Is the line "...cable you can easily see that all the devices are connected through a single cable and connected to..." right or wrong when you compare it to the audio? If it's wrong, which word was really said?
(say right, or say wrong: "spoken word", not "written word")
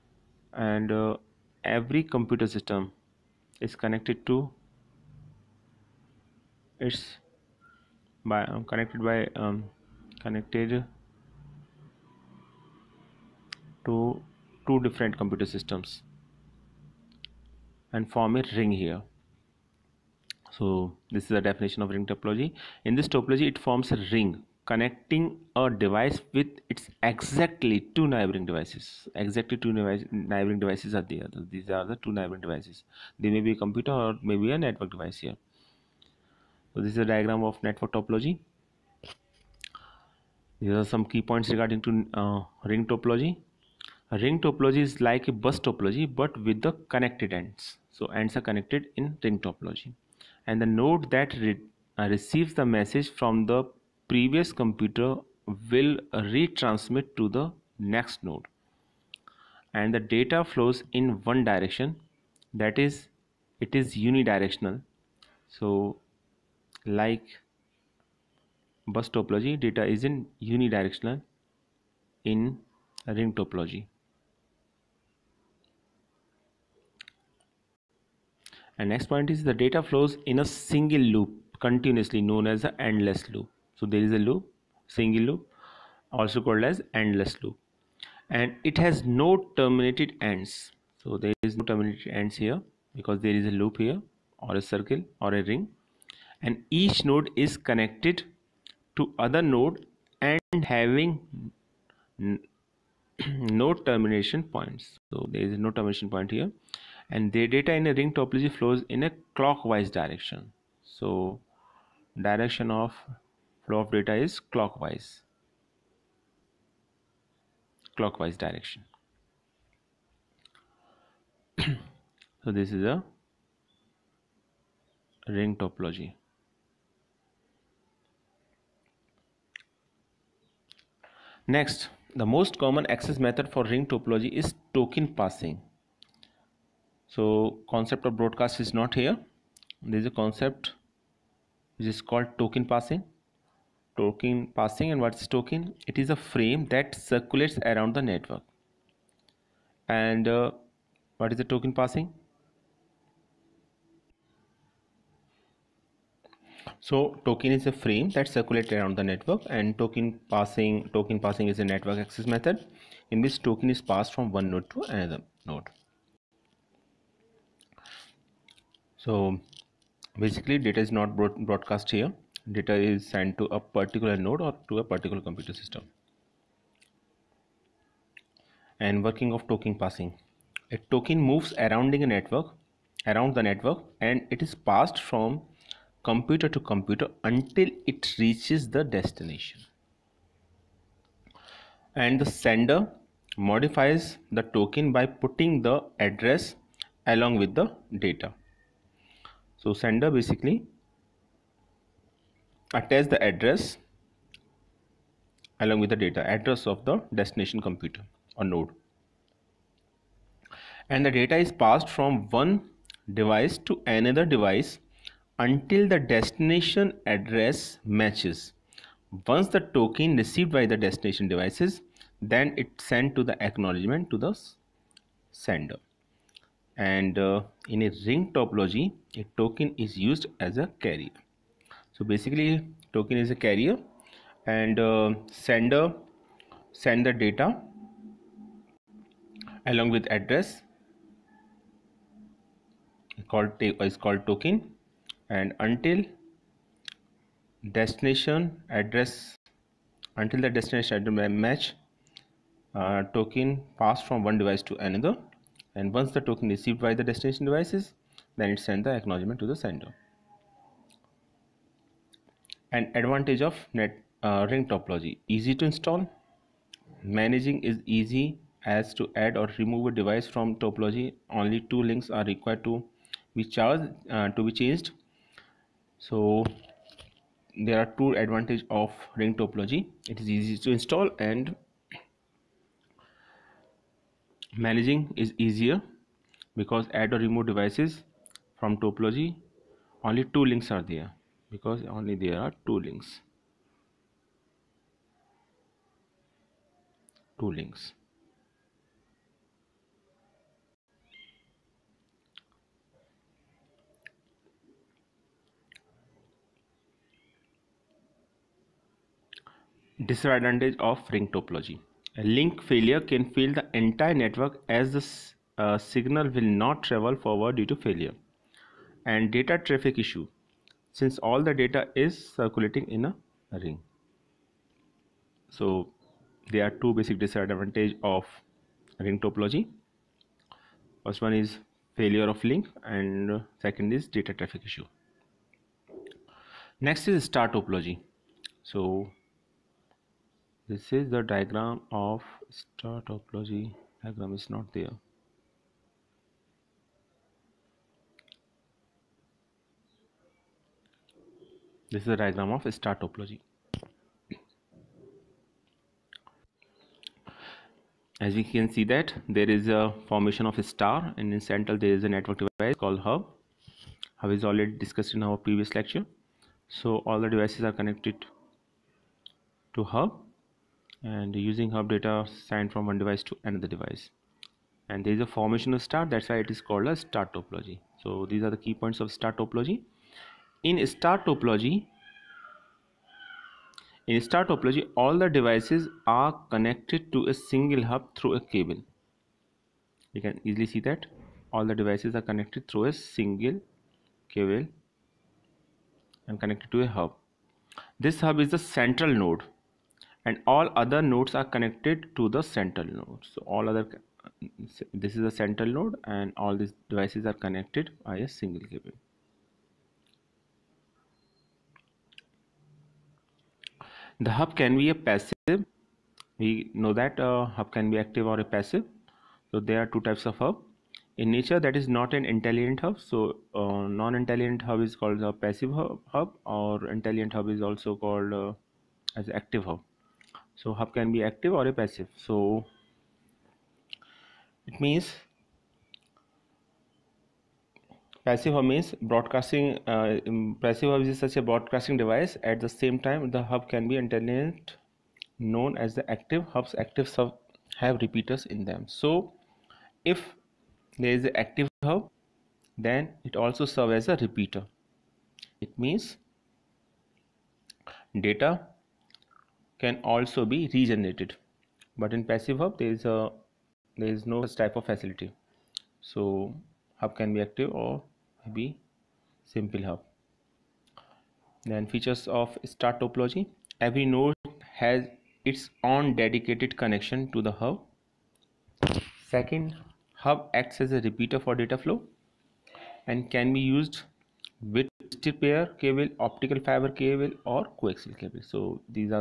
right.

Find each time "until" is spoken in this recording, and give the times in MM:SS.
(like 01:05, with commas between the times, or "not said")
03:07, 03:35, 04:05, 04:10.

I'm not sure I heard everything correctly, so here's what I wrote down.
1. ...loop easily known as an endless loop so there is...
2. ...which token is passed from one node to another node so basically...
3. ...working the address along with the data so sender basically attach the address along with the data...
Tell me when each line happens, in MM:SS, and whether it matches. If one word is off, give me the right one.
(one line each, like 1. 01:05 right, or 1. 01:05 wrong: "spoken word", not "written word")
1. 01:21 wrong: "continuously", not "easily"
2. 02:43 right
3. 03:15 wrong: "putting", not "working".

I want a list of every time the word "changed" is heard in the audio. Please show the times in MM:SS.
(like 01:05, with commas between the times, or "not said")
04:34.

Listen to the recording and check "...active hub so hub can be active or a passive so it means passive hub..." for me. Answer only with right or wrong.
right.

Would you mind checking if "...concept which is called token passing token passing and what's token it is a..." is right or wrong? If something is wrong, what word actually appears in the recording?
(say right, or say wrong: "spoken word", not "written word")
right.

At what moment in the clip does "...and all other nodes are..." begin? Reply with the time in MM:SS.
06:40.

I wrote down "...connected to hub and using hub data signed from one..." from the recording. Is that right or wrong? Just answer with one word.
right.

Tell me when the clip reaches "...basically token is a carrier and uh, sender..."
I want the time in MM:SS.
03:52.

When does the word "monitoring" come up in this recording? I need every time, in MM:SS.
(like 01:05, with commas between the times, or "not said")
not said.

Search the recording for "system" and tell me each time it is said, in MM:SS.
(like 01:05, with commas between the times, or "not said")
00:02, 00:15, 02:55.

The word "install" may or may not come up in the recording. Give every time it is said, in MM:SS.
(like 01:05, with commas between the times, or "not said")
04:25, 04:40.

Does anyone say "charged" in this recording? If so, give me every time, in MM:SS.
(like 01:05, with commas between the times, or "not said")
04:33.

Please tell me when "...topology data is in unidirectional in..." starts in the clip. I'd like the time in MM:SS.
01:09.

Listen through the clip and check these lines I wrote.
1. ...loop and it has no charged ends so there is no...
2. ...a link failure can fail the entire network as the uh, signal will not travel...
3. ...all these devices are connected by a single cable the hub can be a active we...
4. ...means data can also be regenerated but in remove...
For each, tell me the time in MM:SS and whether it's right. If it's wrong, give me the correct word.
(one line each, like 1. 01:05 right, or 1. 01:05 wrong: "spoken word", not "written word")
1. 01:27 wrong: "terminated", not "charged"
2. 05:12 right
3. 06:46 wrong: "passive", not "active"
4. 07:35 wrong: "passive", not "remove".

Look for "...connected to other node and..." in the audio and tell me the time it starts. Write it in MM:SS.
01:37.